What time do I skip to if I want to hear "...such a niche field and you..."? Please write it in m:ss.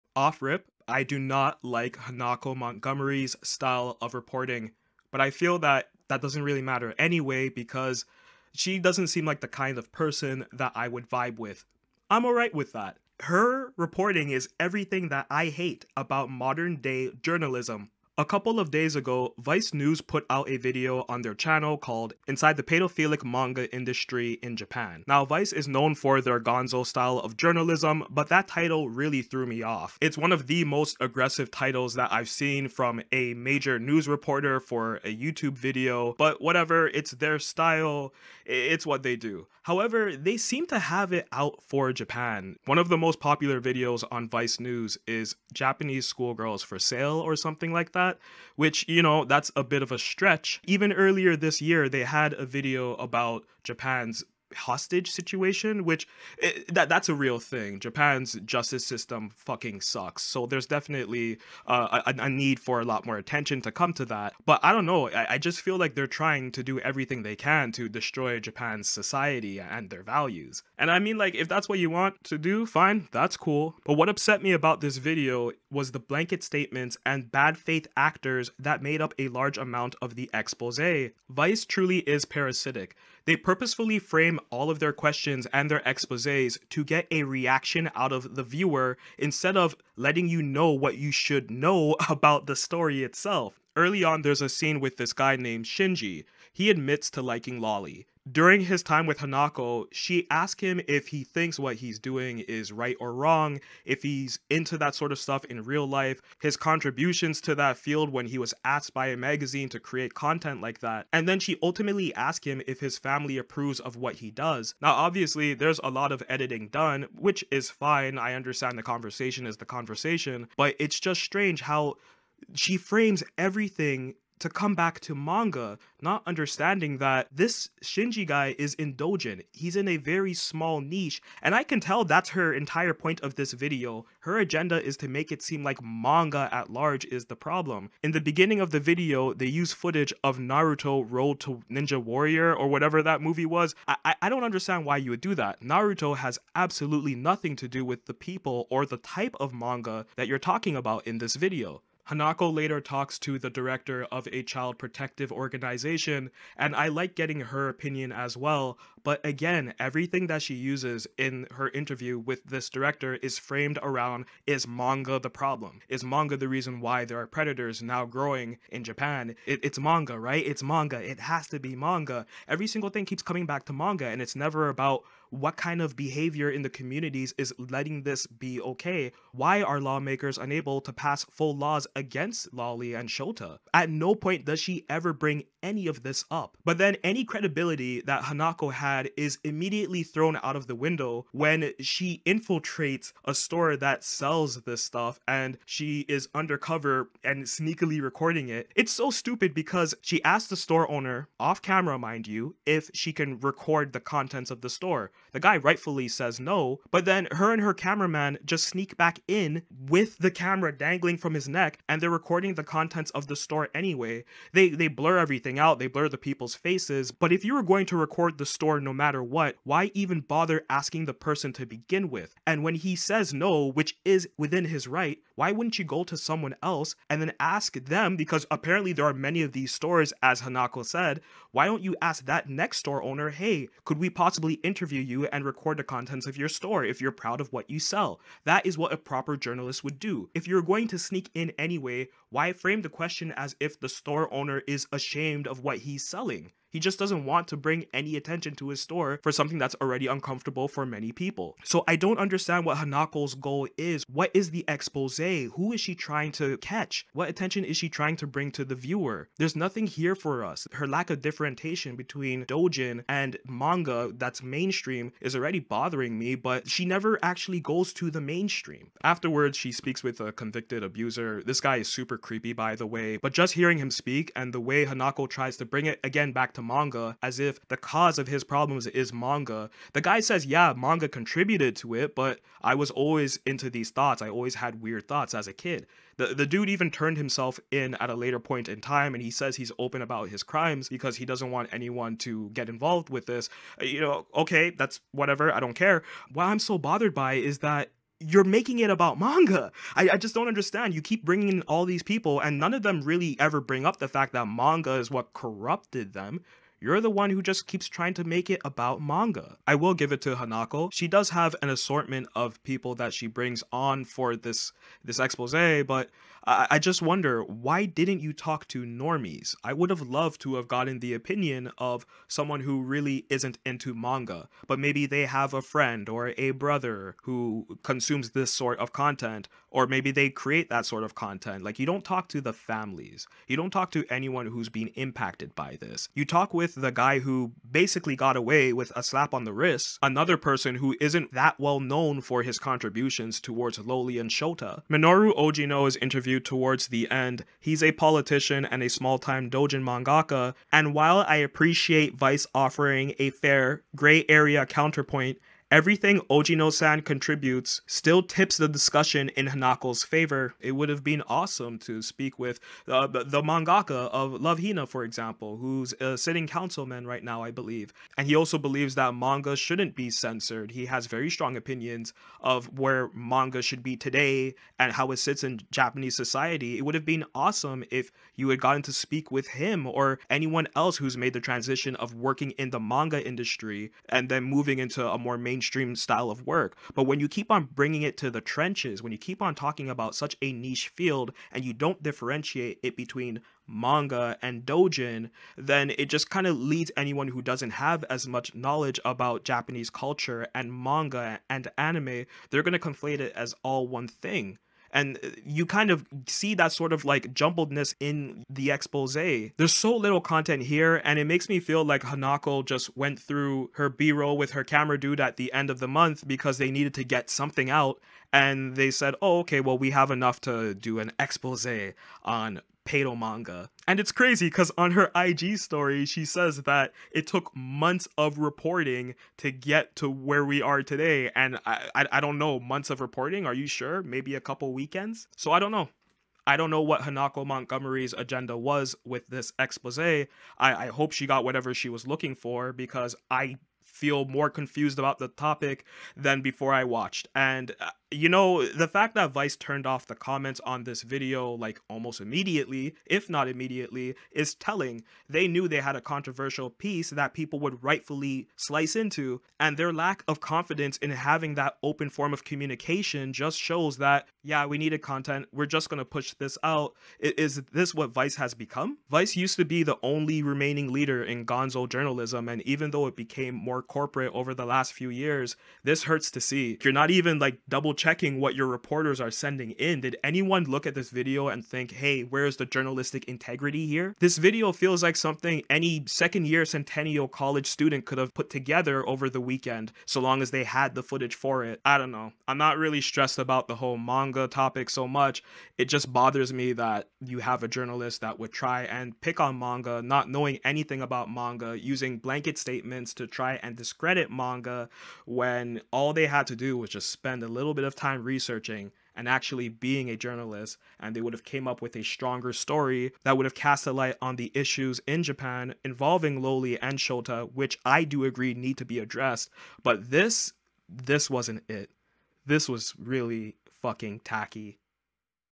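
6:30.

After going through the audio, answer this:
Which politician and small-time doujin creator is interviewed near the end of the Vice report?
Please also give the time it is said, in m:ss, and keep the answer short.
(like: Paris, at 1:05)
Minoru Ojino, at 5:44.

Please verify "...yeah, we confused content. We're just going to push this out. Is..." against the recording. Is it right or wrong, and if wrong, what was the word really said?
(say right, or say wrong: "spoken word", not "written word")
wrong: "needed", not "confused".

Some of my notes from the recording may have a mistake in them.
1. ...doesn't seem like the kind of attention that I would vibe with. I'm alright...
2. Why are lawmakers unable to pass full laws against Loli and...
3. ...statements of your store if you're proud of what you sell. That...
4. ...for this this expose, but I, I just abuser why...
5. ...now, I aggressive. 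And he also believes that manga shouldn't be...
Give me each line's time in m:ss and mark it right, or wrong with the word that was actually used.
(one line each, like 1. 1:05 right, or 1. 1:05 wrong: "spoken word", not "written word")
1. 0:08 wrong: "person", not "attention"
2. 2:59 right
3. 3:55 wrong: "contents", not "statements"
4. 5:14 wrong: "wonder", not "abuser"
5. 6:07 wrong: "believe", not "aggressive".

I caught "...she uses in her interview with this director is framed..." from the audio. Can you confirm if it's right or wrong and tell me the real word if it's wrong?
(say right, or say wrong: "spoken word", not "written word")
right.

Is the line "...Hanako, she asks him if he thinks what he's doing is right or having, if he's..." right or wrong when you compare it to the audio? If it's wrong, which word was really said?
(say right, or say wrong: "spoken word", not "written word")
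wrong: "wrong", not "having".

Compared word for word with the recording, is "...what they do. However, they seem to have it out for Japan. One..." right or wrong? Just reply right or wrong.
right.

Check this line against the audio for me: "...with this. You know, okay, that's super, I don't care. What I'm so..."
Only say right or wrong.
wrong.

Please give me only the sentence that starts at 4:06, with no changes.
He just doesn't want to bring any attention to his store for something that's already uncomfortable for many people.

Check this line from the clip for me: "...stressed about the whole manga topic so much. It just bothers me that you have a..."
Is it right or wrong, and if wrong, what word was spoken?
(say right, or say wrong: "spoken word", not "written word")
right.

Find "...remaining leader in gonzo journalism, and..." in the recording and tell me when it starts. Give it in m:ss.
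7:50.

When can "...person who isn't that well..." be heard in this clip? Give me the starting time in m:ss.
5:40.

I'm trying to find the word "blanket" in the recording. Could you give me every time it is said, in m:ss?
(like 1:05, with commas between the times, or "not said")
1:15, 8:22.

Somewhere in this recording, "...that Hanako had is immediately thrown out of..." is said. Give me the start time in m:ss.
3:08.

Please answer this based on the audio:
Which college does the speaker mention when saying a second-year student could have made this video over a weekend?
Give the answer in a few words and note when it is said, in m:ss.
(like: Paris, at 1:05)
Centennial College, at 8:06.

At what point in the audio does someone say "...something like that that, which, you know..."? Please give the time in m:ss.
0:47.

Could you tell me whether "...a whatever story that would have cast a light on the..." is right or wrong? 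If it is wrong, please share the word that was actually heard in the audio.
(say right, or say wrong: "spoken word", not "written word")
wrong: "stronger", not "whatever".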